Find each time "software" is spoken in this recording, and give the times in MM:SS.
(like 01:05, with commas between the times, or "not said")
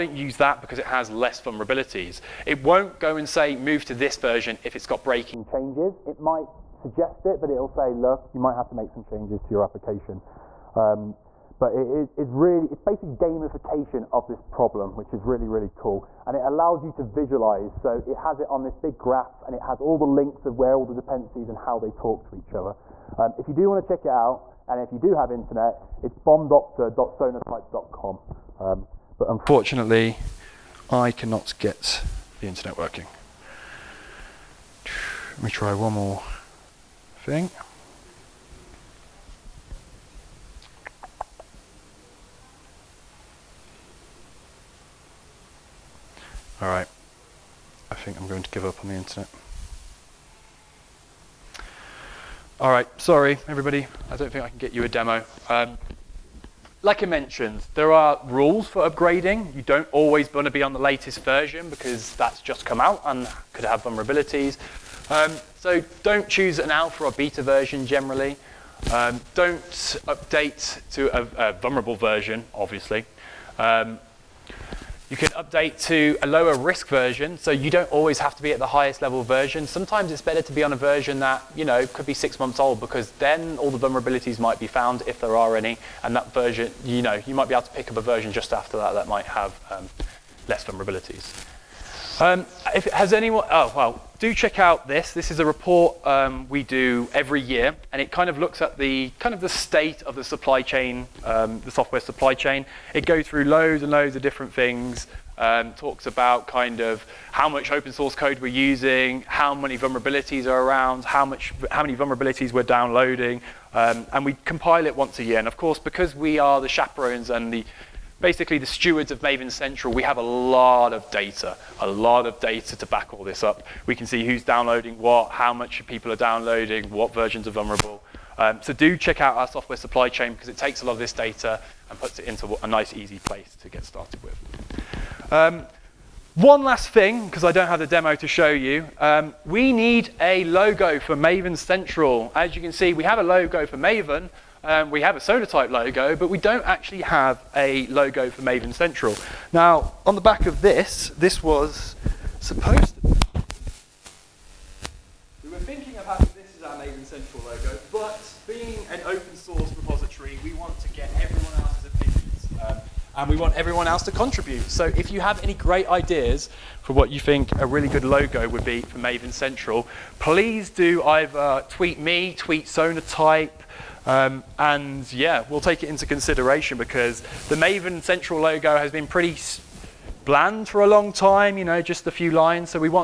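01:41, 02:09.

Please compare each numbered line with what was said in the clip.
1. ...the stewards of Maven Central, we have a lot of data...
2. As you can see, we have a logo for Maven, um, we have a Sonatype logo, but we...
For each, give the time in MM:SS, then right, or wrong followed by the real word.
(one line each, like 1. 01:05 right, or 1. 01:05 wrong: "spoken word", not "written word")
1. 01:58 right
2. 02:22 right.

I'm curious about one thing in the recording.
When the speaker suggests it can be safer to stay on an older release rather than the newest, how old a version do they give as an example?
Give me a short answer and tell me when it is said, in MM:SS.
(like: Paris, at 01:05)
6 months, at 01:22.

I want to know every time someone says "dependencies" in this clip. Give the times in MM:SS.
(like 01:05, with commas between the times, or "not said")
00:20.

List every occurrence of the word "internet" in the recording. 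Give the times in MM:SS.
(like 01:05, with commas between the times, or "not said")
00:25, 00:32, 00:48.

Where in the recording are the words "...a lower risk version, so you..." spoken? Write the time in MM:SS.
01:16.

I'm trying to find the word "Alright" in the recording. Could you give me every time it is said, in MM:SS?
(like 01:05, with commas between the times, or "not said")
00:46, 00:52.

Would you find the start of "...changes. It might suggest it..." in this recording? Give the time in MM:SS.
00:05.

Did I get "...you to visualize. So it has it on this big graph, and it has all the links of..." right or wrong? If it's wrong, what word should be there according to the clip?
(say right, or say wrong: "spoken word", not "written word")
right.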